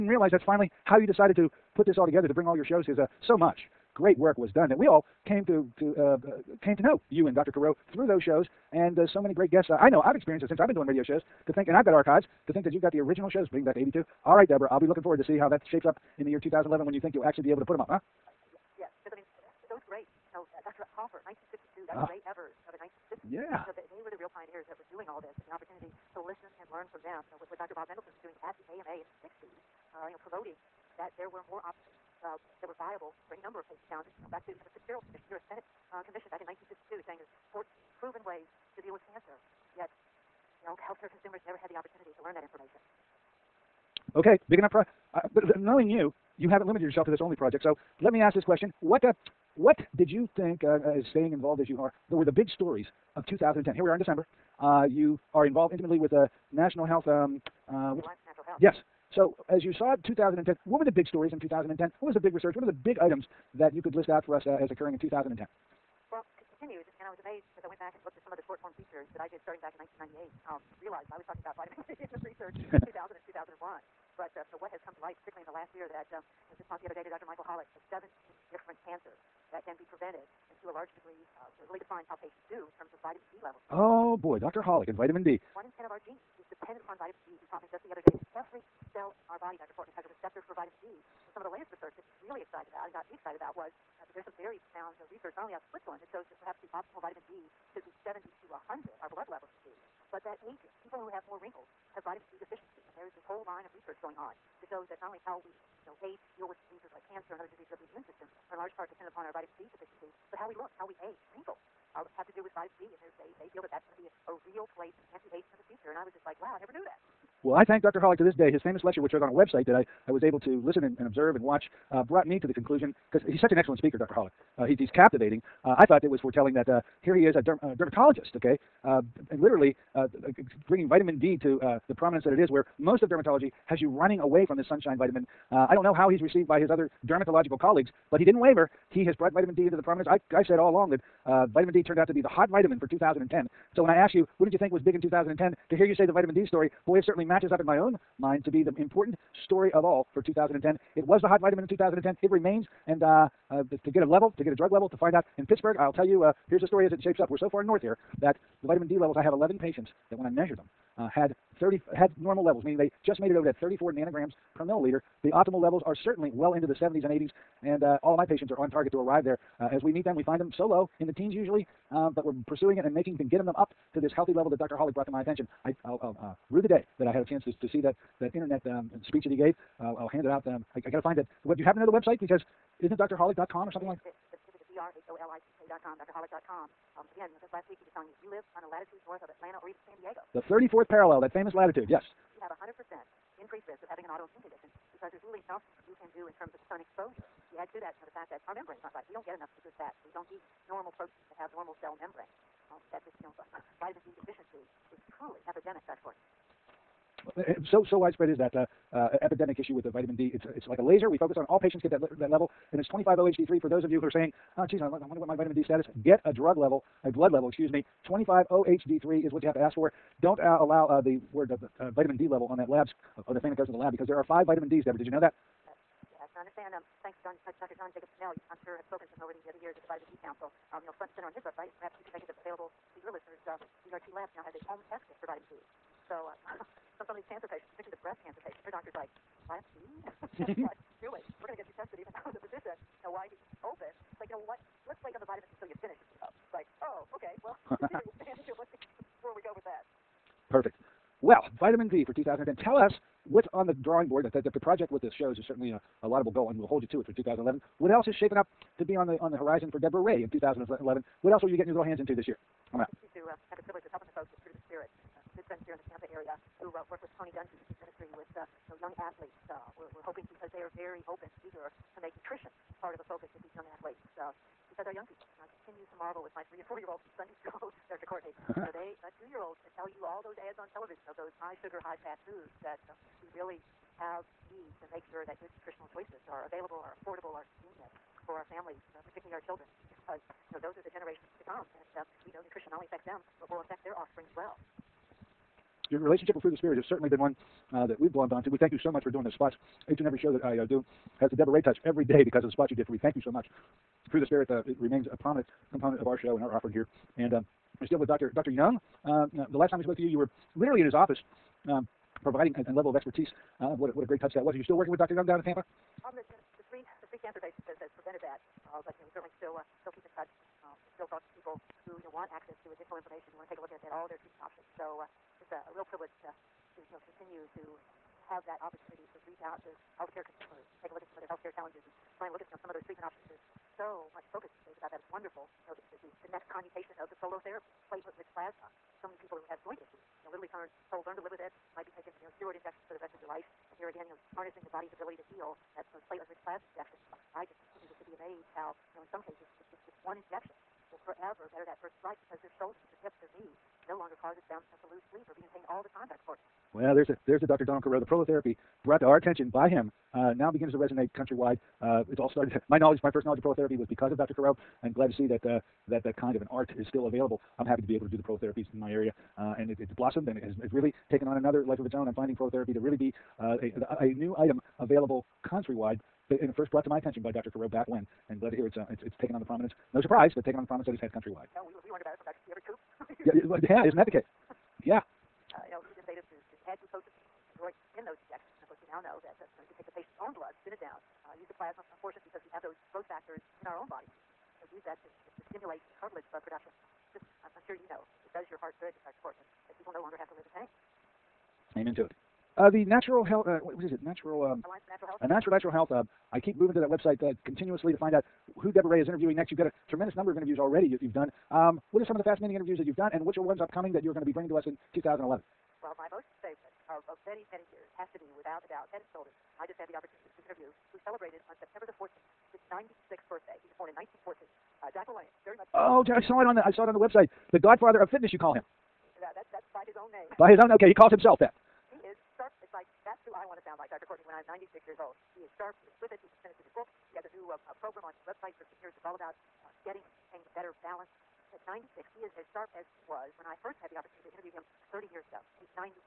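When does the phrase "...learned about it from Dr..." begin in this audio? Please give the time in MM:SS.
06:21.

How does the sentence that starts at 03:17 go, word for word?
You add to that you know, the fact that our membrane's not right.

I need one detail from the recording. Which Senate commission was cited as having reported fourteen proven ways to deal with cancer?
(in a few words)
Fitzgerald Commission.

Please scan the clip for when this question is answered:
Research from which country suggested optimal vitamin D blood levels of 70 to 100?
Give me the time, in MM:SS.
01:35.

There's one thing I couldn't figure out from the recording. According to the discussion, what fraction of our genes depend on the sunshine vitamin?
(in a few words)
One in ten.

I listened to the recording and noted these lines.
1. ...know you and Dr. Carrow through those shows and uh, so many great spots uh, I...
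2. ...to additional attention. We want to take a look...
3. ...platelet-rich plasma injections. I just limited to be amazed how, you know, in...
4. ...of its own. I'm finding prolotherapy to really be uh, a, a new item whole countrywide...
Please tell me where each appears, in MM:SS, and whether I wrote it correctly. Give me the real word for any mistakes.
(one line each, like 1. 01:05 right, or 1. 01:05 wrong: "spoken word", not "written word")
1. 00:06 wrong: "guests", not "spots"
2. 05:22 wrong: "information", not "attention"
3. 05:46 wrong: "needed", not "limited"
4. 06:11 wrong: "available", not "whole".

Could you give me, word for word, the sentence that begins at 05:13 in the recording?
Uh, what, a, what a great touch that was.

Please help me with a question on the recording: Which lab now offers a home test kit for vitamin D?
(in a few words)
ZRT Labs.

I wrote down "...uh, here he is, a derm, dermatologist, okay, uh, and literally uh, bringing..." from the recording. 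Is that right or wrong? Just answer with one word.
right.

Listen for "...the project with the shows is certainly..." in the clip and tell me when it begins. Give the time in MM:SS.
04:14.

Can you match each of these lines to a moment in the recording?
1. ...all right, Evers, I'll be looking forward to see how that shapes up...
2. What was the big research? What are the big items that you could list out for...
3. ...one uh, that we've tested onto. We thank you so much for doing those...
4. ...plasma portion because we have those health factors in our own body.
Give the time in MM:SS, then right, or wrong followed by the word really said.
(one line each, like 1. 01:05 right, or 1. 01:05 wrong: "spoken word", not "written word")
1. 00:14 wrong: "Deborah", not "Evers"
2. 01:02 right
3. 04:57 wrong: "glommed", not "tested"
4. 06:31 wrong: "growth", not "health".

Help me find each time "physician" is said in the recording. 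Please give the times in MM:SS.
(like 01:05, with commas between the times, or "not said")
04:02.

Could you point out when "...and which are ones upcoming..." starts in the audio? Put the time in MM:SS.
06:53.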